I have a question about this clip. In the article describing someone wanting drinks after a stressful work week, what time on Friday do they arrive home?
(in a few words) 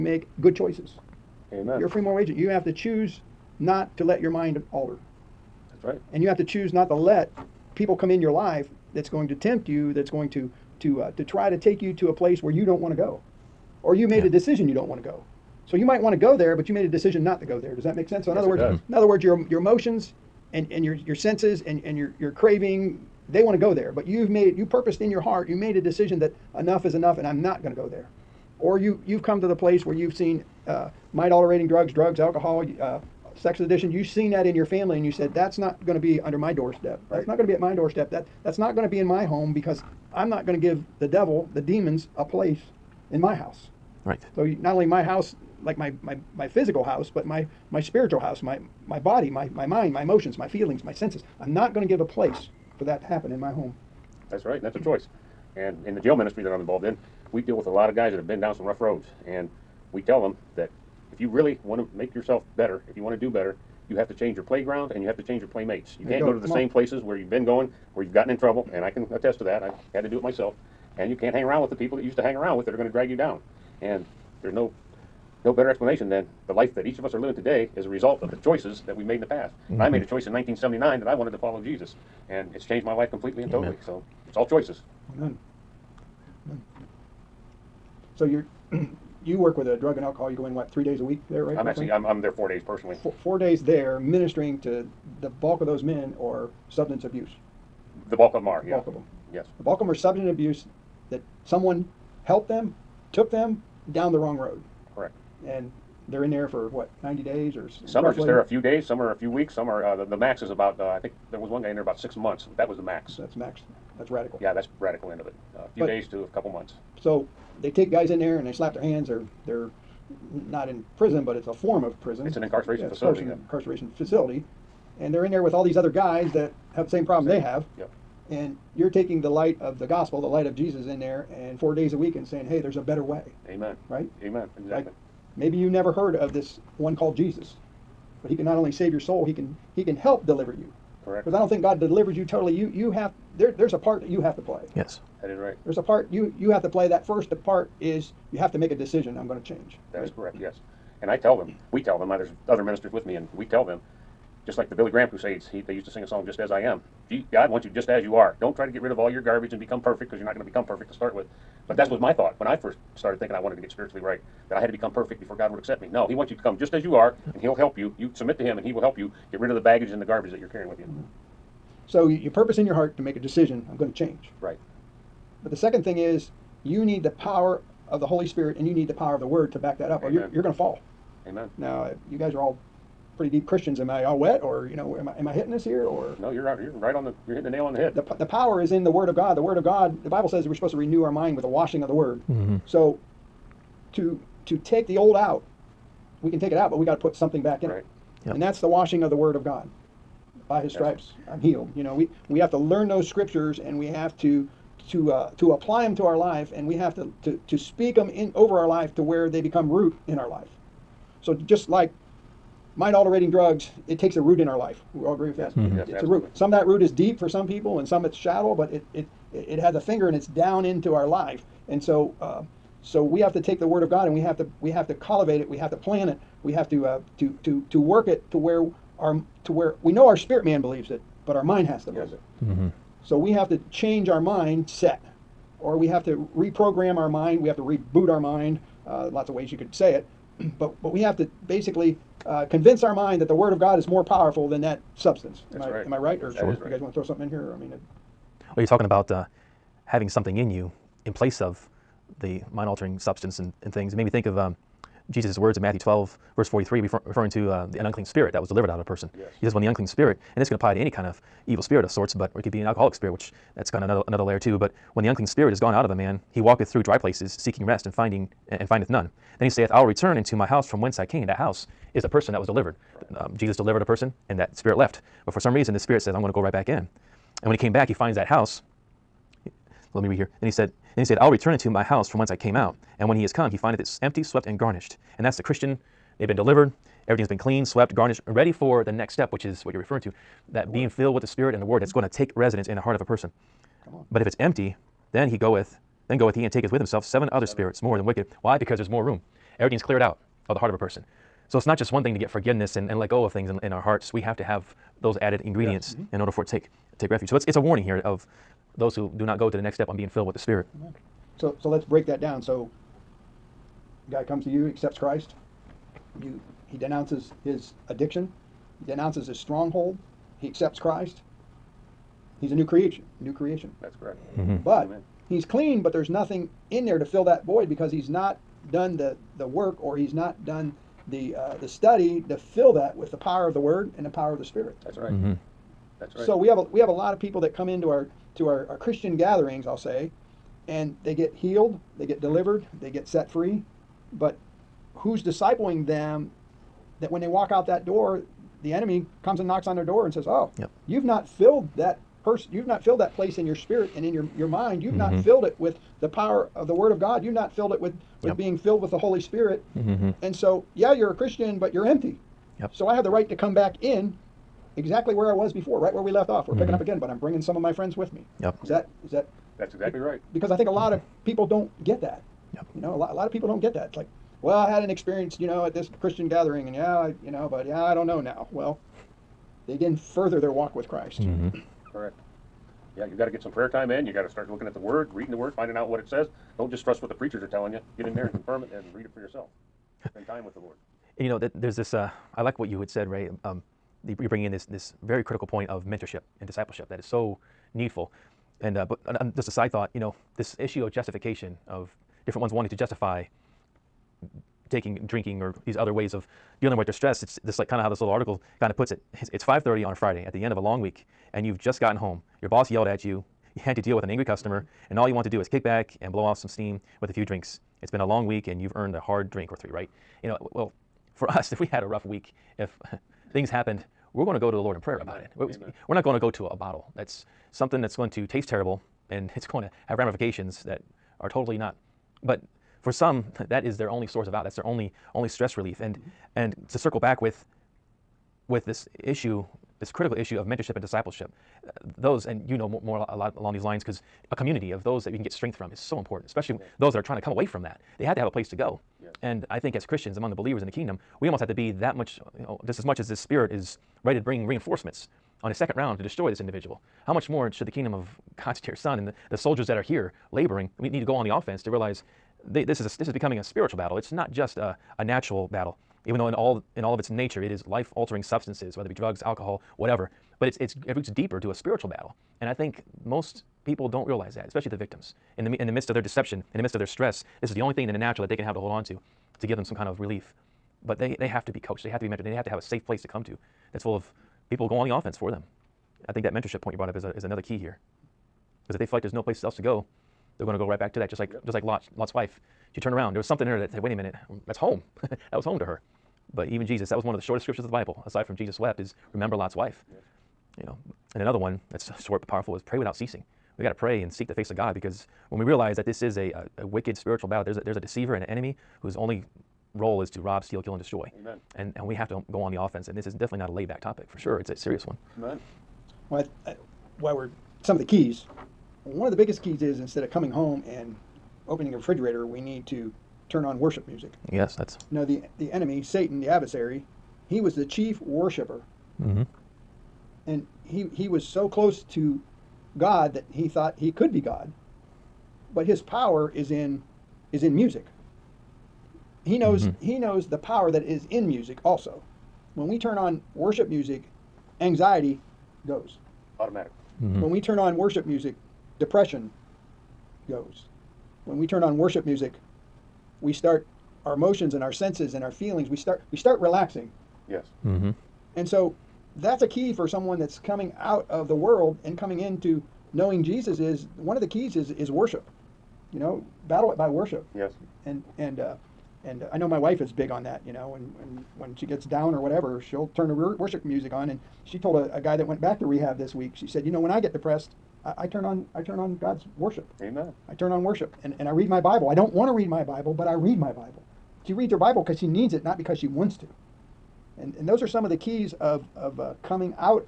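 5:30.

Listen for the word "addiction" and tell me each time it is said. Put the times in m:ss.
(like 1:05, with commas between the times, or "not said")
0:33, 5:17.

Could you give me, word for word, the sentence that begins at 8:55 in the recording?
But his power is in is in music.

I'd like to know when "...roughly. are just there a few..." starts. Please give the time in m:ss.
1:48.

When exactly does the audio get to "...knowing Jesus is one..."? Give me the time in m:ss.
9:22.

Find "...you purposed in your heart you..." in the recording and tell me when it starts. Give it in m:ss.
0:24.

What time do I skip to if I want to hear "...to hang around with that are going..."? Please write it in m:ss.
1:12.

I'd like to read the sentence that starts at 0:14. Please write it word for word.
a decision you don't want to go.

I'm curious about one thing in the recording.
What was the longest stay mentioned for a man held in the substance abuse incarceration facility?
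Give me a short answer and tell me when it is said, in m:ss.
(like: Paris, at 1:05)
6 months, at 1:51.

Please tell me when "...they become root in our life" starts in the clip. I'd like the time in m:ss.
3:29.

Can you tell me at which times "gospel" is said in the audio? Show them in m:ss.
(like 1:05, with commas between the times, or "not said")
2:09.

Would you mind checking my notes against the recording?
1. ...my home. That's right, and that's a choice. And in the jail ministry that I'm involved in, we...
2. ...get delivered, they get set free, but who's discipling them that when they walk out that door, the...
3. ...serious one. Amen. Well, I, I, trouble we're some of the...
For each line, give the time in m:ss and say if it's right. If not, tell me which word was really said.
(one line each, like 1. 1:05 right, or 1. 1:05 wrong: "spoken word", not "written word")
1. 0:53 right
2. 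5:42 right
3. 8:34 wrong: "while", not "trouble".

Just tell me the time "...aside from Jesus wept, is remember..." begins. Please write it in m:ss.
8:18.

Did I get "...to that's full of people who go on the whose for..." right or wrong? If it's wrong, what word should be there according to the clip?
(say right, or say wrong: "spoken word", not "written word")
wrong: "offense", not "whose".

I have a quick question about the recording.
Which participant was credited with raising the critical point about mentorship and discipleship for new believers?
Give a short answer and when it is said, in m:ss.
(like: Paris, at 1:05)
Ray, at 6:33.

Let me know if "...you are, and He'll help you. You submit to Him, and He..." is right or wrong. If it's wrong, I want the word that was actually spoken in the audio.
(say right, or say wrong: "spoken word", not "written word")
right.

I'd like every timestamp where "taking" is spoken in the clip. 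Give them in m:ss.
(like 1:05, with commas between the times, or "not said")
2:08, 6:44.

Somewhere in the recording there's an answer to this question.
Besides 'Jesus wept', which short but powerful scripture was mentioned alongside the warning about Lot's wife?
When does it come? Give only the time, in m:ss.
8:22.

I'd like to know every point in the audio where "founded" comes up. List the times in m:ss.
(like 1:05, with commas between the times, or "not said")
not said.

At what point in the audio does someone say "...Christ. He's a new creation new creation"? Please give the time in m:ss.
5:20.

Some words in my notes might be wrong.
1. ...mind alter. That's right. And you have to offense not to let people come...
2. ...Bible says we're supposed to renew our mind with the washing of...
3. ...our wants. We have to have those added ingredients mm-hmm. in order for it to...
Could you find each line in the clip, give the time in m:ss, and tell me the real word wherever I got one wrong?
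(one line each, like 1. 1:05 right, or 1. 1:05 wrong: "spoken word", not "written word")
1. 0:04 wrong: "choose", not "offense"
2. 3:10 right
3. 5:03 wrong: "hearts", not "wants".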